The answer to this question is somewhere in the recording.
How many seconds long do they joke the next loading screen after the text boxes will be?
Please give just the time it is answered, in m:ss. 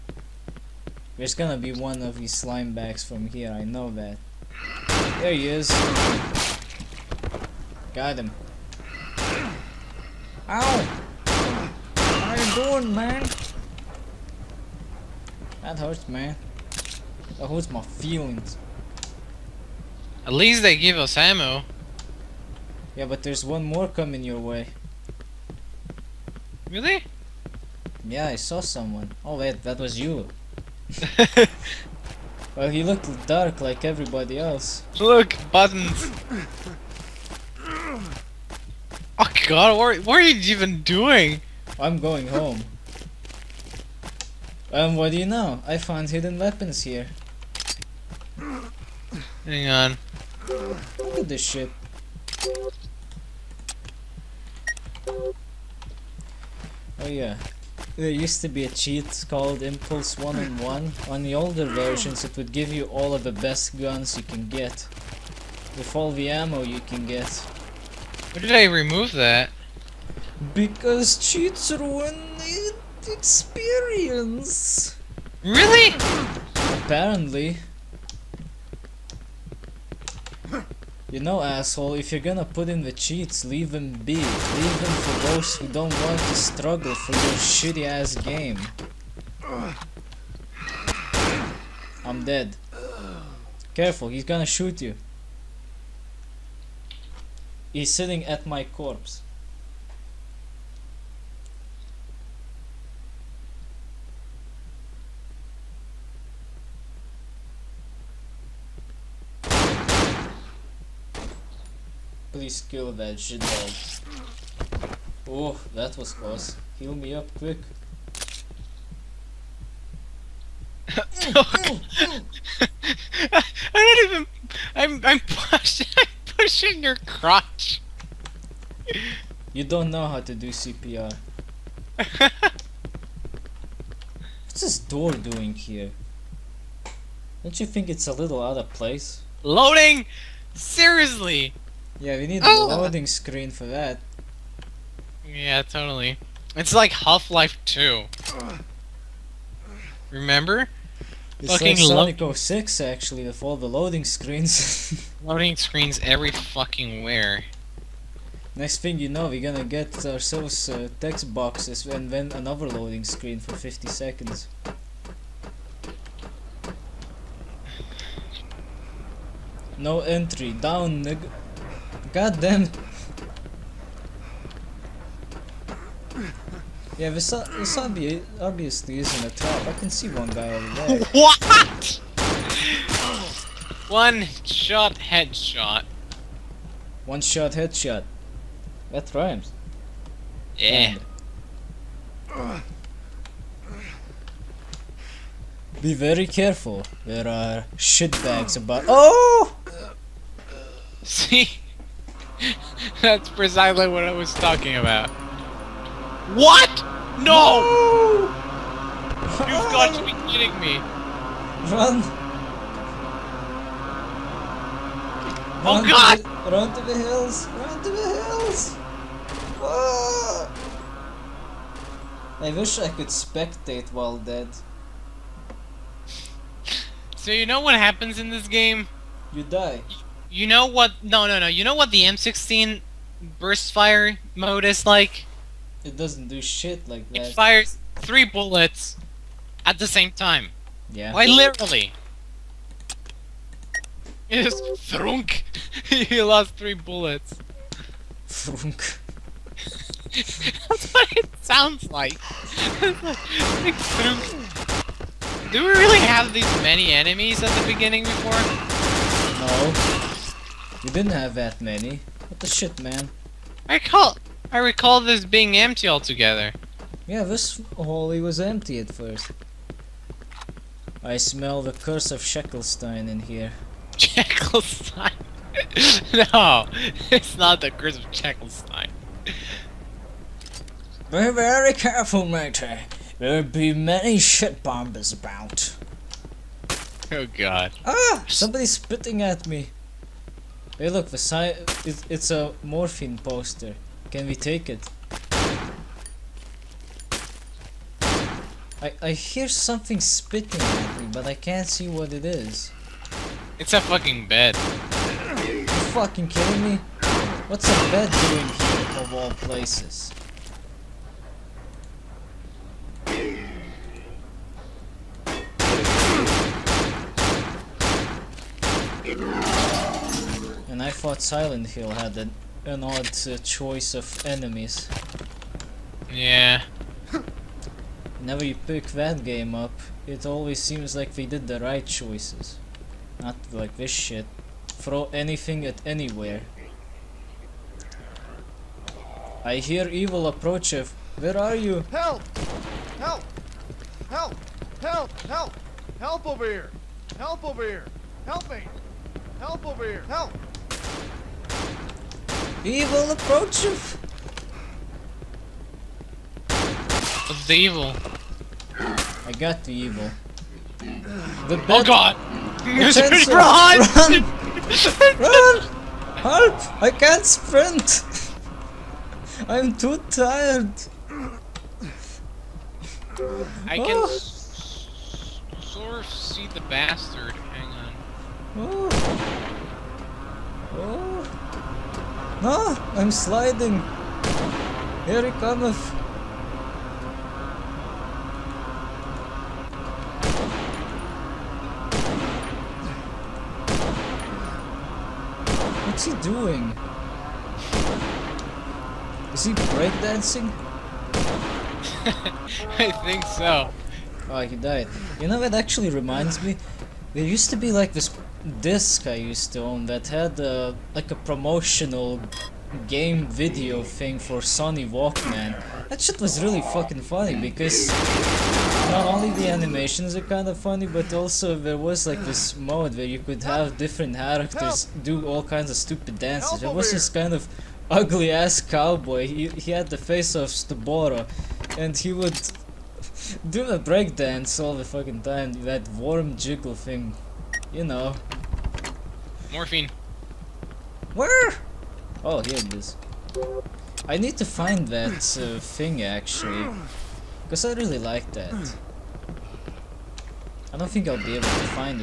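2:43.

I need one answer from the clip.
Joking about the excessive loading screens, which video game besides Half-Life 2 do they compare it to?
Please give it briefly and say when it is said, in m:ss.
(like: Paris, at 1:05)
Sonic 06, at 2:32.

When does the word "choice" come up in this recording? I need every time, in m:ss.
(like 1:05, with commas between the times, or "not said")
5:23, 5:31.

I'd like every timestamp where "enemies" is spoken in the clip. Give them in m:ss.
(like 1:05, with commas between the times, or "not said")
4:16, 5:24.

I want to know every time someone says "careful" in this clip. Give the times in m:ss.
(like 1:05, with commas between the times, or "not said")
1:33, 3:16, 4:41.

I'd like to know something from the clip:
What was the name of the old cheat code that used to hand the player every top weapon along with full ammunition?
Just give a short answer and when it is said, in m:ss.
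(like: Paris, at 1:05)
Impulse 1 on 1, at 0:59.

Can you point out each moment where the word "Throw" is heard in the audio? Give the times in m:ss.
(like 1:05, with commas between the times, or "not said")
5:34.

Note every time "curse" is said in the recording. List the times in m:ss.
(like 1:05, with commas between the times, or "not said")
4:31, 4:37.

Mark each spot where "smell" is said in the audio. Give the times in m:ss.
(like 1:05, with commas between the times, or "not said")
4:31.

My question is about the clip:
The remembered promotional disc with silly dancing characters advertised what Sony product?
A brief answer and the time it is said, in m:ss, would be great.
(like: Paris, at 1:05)
Sony Walkman, at 6:54.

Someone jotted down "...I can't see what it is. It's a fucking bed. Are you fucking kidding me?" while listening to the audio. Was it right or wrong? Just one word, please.
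right.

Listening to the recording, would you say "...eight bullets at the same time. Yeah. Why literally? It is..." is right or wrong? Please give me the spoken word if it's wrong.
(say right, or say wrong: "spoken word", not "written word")
wrong: "three", not "eight".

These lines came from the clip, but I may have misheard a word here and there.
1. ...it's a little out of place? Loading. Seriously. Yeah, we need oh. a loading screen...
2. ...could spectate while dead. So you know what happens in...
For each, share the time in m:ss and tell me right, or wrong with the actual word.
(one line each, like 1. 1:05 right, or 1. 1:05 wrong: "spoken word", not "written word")
1. 2:17 right
2. 3:42 right.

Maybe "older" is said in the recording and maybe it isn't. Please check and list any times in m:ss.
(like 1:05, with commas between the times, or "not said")
1:01.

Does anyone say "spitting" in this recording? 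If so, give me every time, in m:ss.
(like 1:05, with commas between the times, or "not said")
4:48, 4:59.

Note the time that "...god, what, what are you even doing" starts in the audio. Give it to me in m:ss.
0:39.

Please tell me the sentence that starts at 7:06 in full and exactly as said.
There was this kind of ugly ass cowboy.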